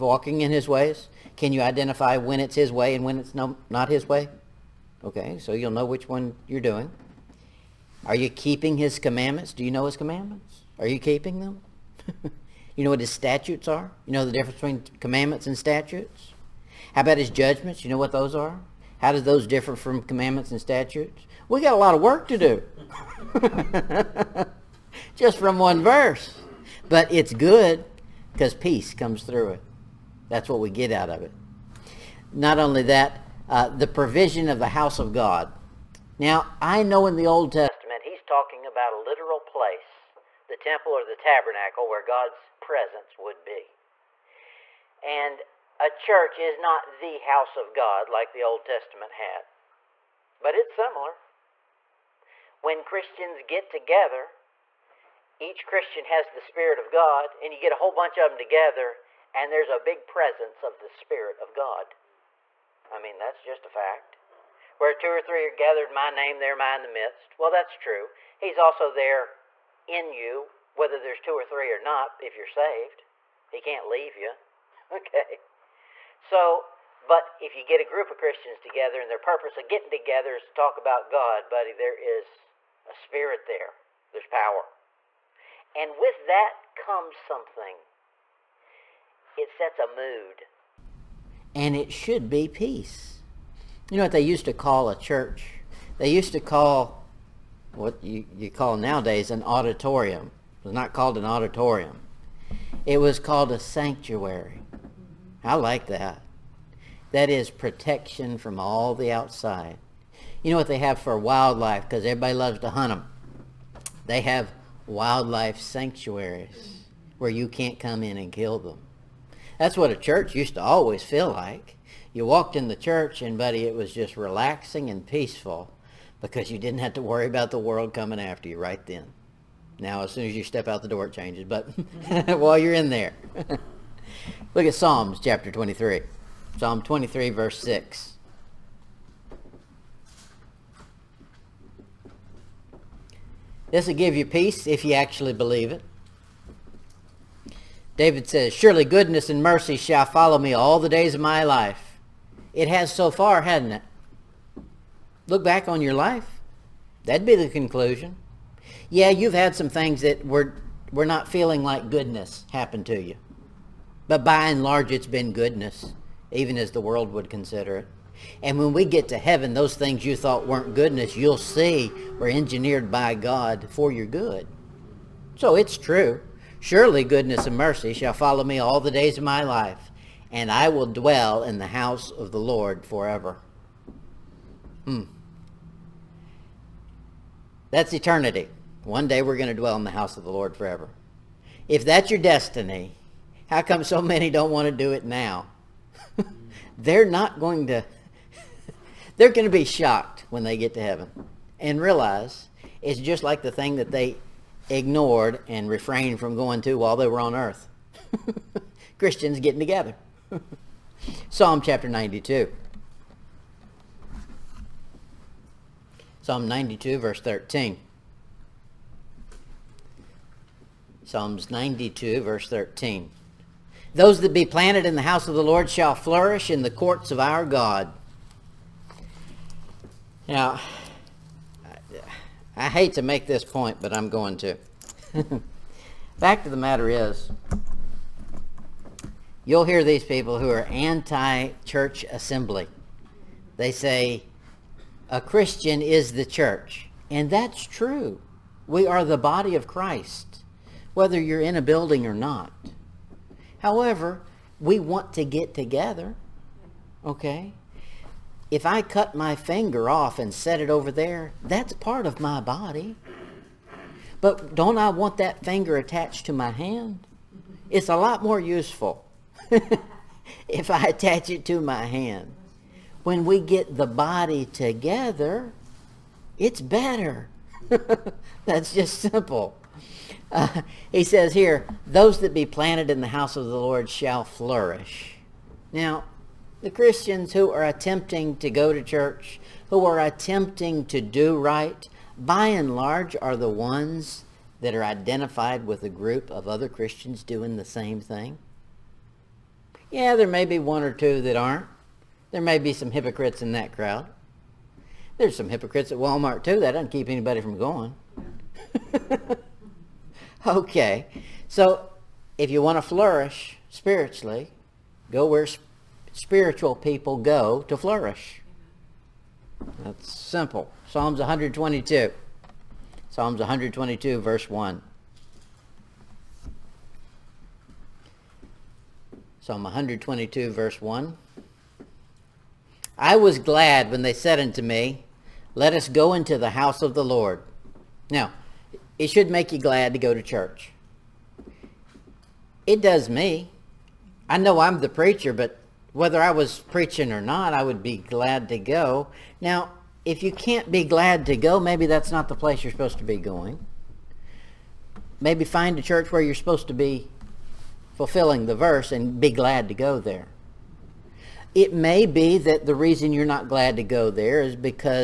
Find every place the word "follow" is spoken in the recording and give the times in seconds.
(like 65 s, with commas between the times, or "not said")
150 s, 178 s.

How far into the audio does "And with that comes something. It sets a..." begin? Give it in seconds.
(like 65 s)
85 s.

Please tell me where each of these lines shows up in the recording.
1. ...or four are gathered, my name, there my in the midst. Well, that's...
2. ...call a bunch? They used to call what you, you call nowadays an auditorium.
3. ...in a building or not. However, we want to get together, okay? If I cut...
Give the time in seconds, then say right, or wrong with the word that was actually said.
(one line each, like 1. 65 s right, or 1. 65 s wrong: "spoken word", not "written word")
1. 65 s wrong: "three", not "four"
2. 94 s wrong: "church", not "bunch"
3. 251 s right.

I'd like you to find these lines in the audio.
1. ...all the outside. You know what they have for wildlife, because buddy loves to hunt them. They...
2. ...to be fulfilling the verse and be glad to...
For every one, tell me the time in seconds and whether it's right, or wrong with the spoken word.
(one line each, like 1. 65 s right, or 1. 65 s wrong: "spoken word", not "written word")
1. 108 s wrong: "everybody", not "buddy"
2. 356 s right.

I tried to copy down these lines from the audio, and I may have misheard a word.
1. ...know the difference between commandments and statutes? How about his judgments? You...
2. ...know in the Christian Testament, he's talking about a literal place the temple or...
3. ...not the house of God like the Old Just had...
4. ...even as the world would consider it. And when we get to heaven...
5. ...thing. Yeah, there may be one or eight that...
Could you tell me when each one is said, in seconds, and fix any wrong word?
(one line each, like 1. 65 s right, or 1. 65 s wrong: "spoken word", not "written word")
1. 14 s right
2. 36 s wrong: "Old", not "Christian"
3. 46 s wrong: "Testament", not "Just"
4. 166 s right
5. 297 s wrong: "two", not "eight".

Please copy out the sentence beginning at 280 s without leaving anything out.
Uh, he says here, those that be planted in the house of the Lord shall flourish.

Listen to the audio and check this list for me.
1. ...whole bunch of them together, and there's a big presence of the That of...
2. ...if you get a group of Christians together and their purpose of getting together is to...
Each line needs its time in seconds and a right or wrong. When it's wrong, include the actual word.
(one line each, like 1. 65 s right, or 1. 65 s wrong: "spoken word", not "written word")
1. 57 s wrong: "Spirit", not "That"
2. 77 s right.